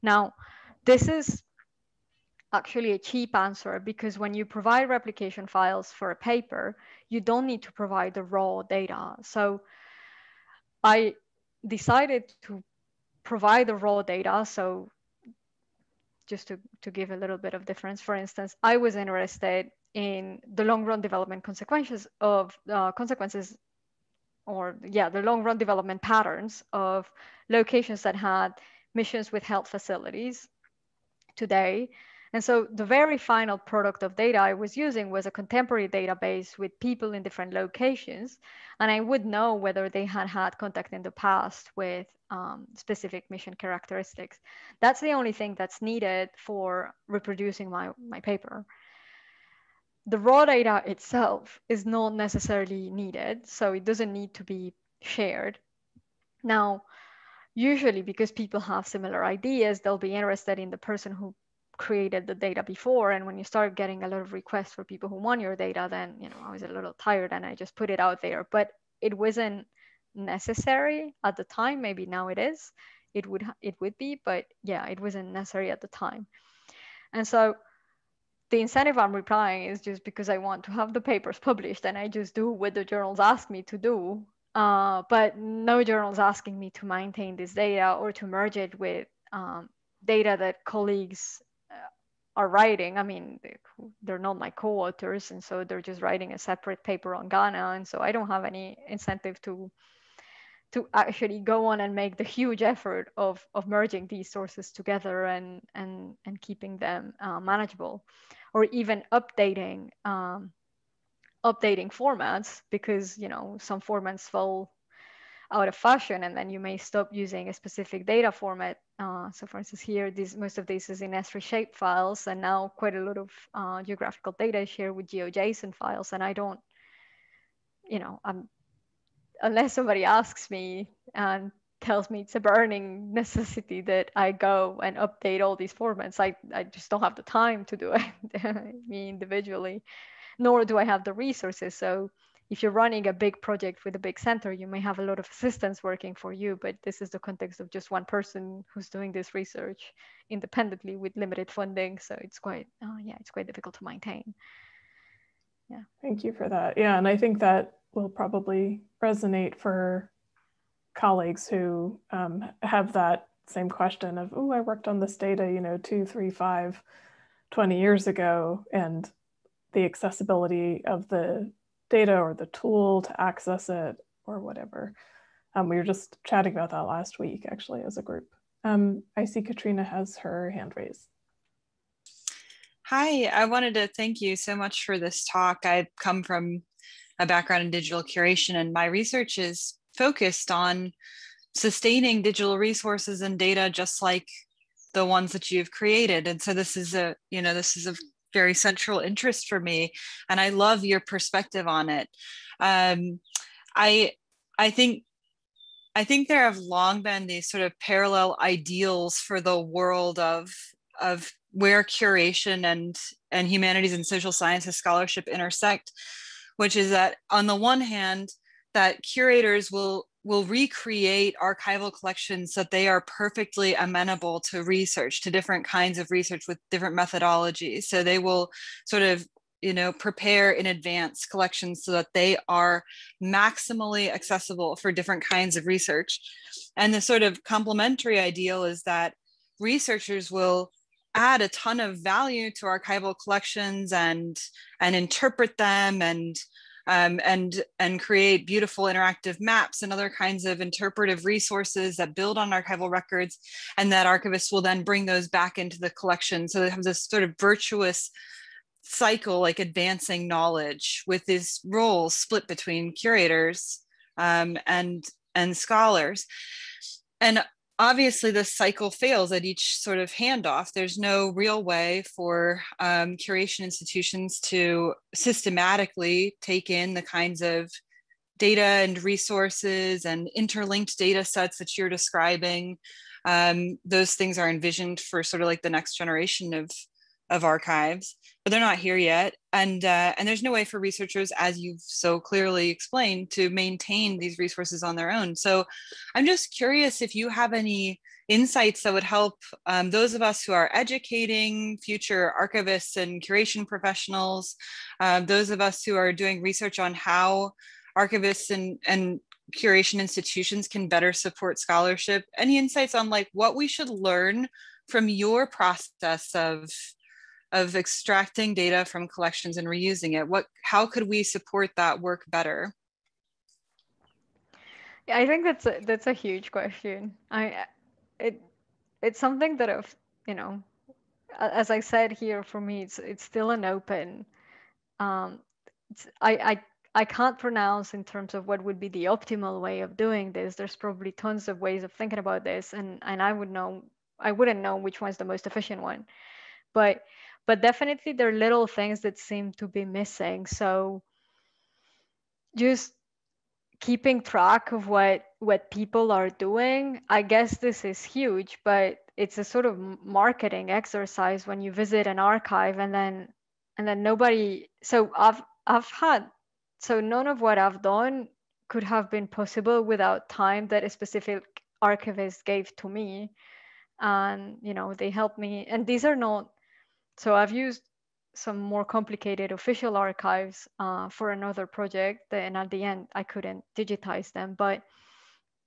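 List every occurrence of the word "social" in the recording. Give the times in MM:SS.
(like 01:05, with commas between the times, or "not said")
03:34.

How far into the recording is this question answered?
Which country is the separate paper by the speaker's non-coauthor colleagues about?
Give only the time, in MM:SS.
01:37.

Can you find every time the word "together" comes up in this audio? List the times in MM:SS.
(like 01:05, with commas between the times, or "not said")
01:44.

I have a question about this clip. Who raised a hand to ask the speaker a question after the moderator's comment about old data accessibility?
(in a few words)
Katrina.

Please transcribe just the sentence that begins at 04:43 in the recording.
Um, those things are envisioned for sort of like the next generation of of archives, but they're not here yet.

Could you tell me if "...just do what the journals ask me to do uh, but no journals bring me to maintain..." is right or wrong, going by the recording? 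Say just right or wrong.
wrong.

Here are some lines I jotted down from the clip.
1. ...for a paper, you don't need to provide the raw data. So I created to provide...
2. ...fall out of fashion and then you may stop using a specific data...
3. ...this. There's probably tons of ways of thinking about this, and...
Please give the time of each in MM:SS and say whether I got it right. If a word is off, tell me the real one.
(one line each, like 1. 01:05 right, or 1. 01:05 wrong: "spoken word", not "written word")
1. 00:05 wrong: "decided", not "created"
2. 01:54 right
3. 05:40 right.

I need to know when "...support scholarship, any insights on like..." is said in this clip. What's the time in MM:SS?
05:11.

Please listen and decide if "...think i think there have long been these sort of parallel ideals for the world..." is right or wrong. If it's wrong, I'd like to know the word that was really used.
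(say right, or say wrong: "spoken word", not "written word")
right.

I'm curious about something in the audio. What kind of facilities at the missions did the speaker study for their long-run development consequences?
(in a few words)
Health facilities.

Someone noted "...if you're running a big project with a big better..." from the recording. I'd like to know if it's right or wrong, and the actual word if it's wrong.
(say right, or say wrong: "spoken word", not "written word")
wrong: "center", not "better".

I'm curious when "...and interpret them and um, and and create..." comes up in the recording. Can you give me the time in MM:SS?
04:04.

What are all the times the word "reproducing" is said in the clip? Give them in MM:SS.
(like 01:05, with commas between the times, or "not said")
00:47.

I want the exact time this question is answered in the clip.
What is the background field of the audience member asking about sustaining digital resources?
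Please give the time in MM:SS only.
03:07.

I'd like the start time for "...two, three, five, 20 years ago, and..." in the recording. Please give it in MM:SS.
02:45.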